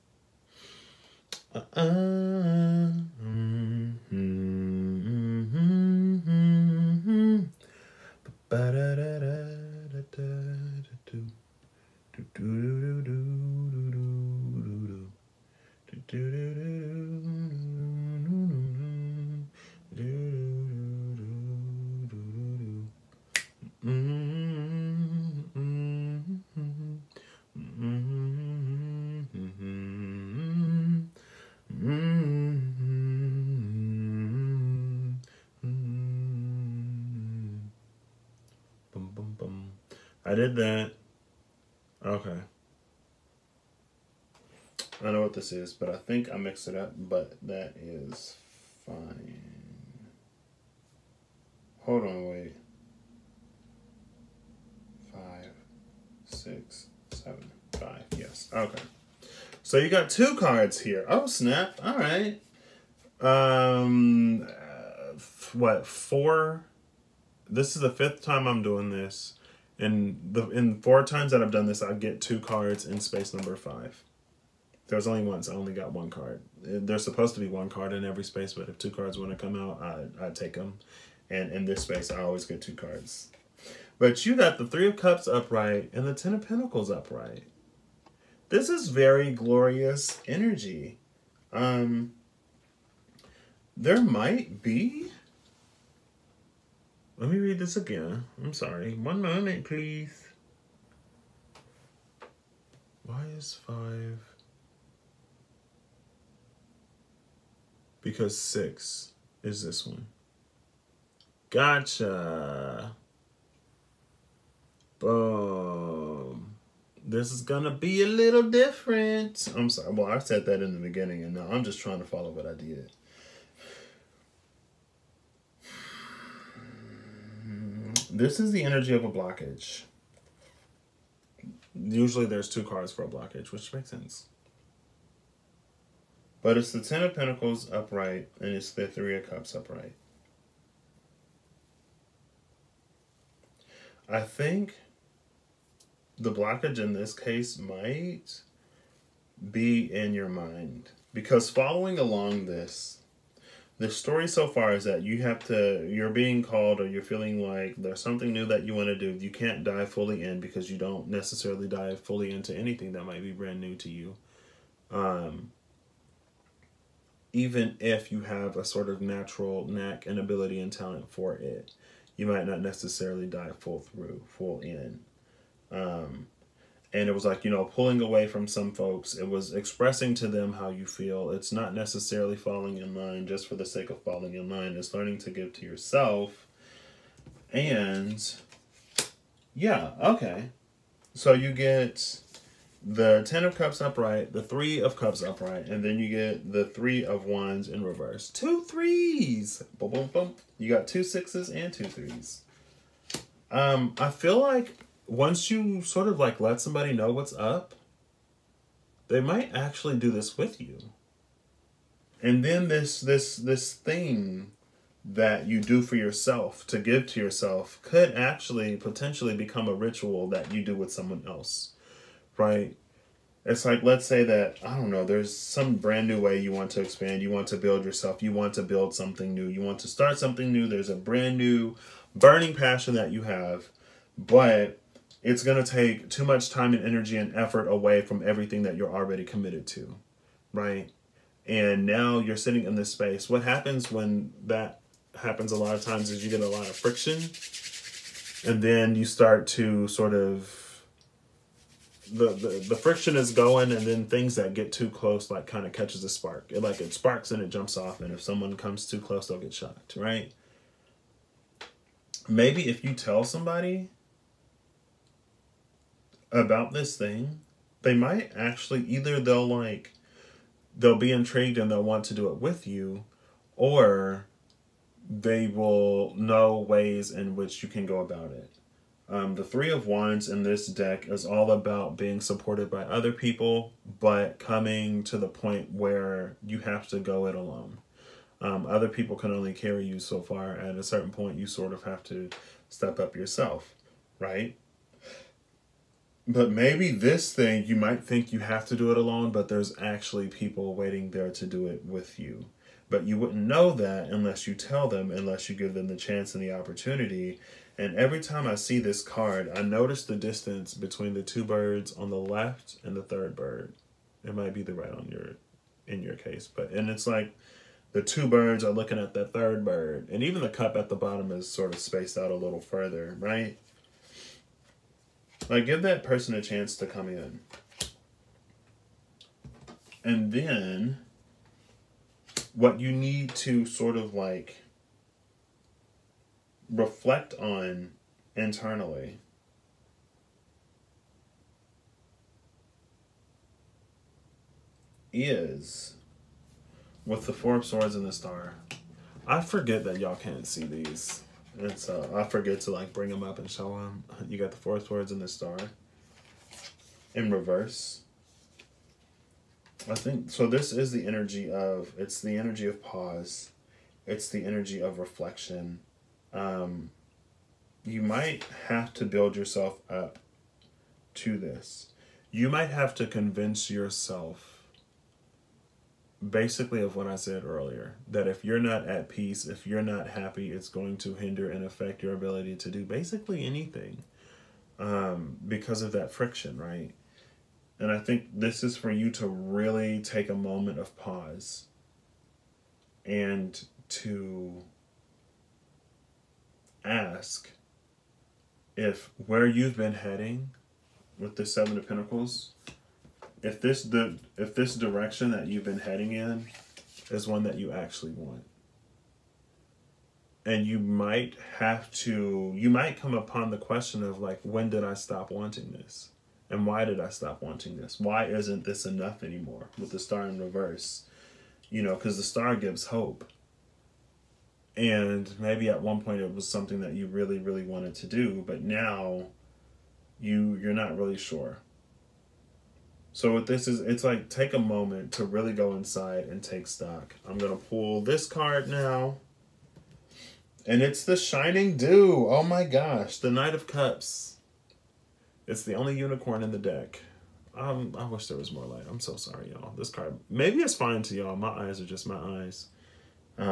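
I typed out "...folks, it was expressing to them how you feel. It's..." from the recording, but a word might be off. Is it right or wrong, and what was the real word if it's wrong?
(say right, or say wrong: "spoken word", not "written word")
right.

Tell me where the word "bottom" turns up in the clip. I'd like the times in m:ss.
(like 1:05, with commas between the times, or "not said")
5:20.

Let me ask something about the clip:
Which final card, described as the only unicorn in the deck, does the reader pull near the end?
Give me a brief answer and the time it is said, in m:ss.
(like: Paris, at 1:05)
Knight of Cups, at 7:23.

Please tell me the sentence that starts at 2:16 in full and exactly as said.
But it's the Ten of Pentacles upright, and it's the Three of Cups upright.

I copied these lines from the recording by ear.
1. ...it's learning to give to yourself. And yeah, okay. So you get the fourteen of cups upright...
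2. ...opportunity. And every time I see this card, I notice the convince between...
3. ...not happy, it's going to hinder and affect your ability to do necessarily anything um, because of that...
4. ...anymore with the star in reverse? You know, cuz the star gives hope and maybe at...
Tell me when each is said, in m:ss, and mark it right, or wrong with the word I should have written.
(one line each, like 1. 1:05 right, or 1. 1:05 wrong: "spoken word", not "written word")
1. 3:04 wrong: "ten", not "fourteen"
2. 5:06 wrong: "distance", not "convince"
3. 6:19 wrong: "basically", not "necessarily"
4. 6:59 right.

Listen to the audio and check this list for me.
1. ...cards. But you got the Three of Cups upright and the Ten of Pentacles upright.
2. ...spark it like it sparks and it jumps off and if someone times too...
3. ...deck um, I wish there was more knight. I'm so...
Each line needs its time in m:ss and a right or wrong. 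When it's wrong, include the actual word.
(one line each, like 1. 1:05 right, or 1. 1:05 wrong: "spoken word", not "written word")
1. 1:22 right
2. 4:16 wrong: "comes", not "times"
3. 7:26 wrong: "light", not "knight".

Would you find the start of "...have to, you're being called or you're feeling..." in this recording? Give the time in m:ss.
2:35.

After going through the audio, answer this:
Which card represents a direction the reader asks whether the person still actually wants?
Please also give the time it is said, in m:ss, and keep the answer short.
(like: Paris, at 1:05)
Seven of Pentacles, at 6:41.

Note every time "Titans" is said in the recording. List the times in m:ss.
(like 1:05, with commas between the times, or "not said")
not said.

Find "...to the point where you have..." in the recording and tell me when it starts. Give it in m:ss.
4:45.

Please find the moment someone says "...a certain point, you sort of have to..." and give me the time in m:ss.
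4:50.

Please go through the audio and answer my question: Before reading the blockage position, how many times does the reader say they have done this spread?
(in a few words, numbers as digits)
5.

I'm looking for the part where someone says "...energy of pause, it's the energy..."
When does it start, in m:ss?
6:02.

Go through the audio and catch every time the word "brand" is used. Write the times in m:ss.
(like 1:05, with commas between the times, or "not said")
2:43, 3:45, 3:50.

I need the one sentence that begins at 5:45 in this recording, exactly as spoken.
Is with the Four of Swords and the Star.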